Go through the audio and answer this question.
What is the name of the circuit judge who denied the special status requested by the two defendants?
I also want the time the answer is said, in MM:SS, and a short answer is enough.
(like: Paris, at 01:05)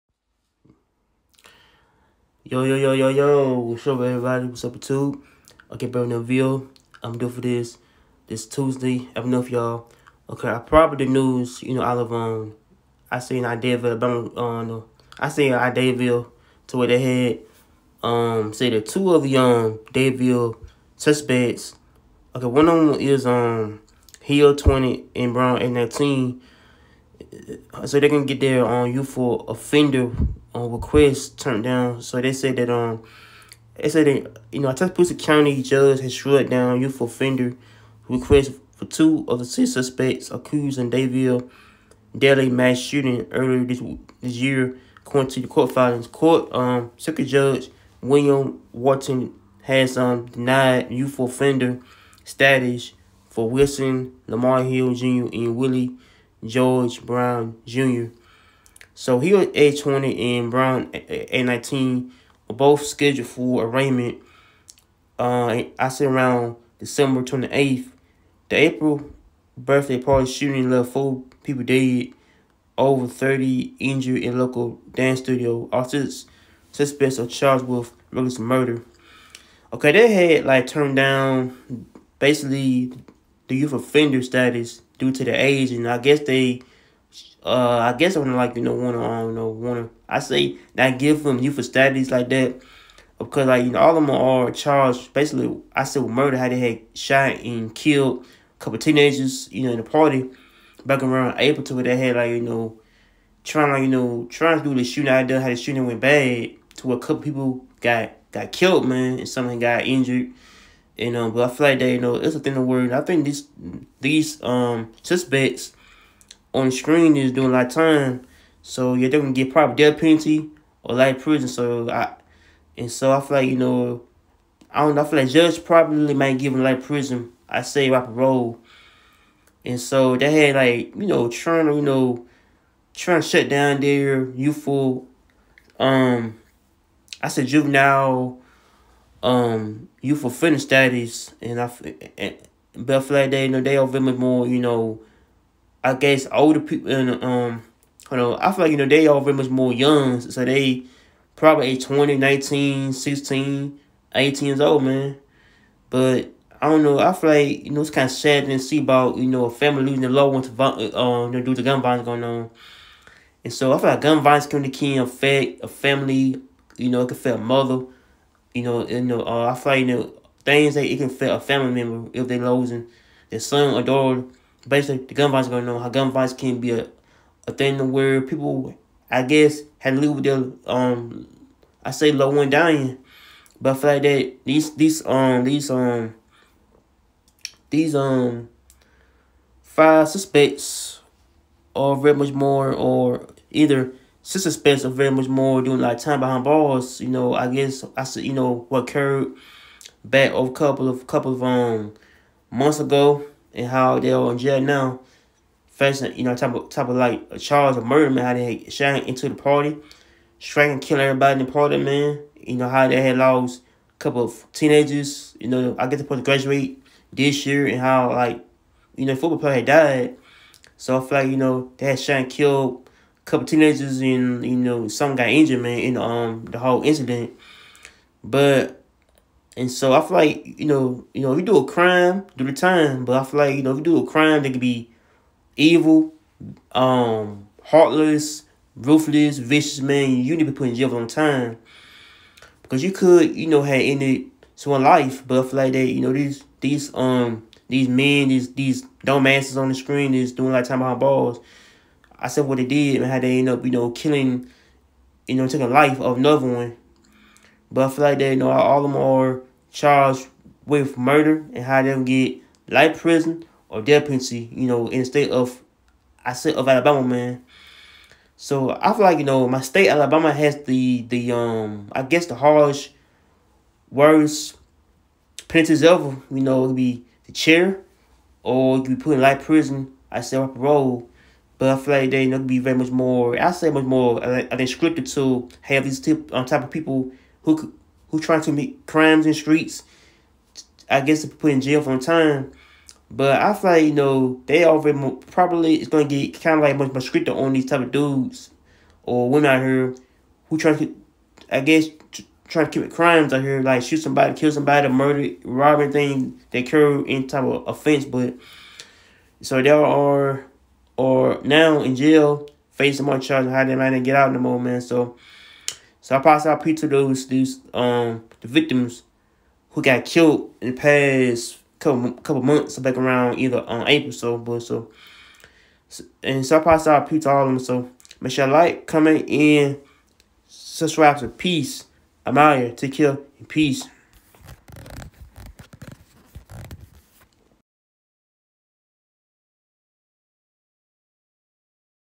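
William Wharton, at 00:48.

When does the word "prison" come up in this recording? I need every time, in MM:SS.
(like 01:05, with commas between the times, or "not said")
02:01, 02:06, 04:23, 04:39.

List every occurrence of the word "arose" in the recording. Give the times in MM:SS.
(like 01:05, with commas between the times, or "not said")
not said.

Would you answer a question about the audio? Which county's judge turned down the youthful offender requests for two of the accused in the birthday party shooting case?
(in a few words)
Tuscaloosa County.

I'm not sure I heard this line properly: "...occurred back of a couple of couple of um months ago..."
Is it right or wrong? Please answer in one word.
right.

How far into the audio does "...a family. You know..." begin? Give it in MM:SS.
02:45.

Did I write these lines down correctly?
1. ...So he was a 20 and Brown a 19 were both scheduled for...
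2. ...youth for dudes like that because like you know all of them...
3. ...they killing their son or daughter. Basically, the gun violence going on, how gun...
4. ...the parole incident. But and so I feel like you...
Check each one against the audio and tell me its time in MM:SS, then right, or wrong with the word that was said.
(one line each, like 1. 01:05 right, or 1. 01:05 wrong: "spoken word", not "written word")
1. 00:58 right
2. 01:31 wrong: "studies", not "dudes"
3. 02:52 wrong: "losing", not "killing"
4. 03:46 wrong: "whole", not "parole".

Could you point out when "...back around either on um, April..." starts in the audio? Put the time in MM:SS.
05:22.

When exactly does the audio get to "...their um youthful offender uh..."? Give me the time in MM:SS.
00:28.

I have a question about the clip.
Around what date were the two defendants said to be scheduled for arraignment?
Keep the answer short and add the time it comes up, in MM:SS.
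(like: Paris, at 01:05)
December 28, at 01:06.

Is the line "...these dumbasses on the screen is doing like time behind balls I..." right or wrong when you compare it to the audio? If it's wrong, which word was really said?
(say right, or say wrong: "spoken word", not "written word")
right.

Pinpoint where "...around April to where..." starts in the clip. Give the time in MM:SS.
01:41.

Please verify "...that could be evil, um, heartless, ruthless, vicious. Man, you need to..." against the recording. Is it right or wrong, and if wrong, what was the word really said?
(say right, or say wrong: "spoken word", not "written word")
right.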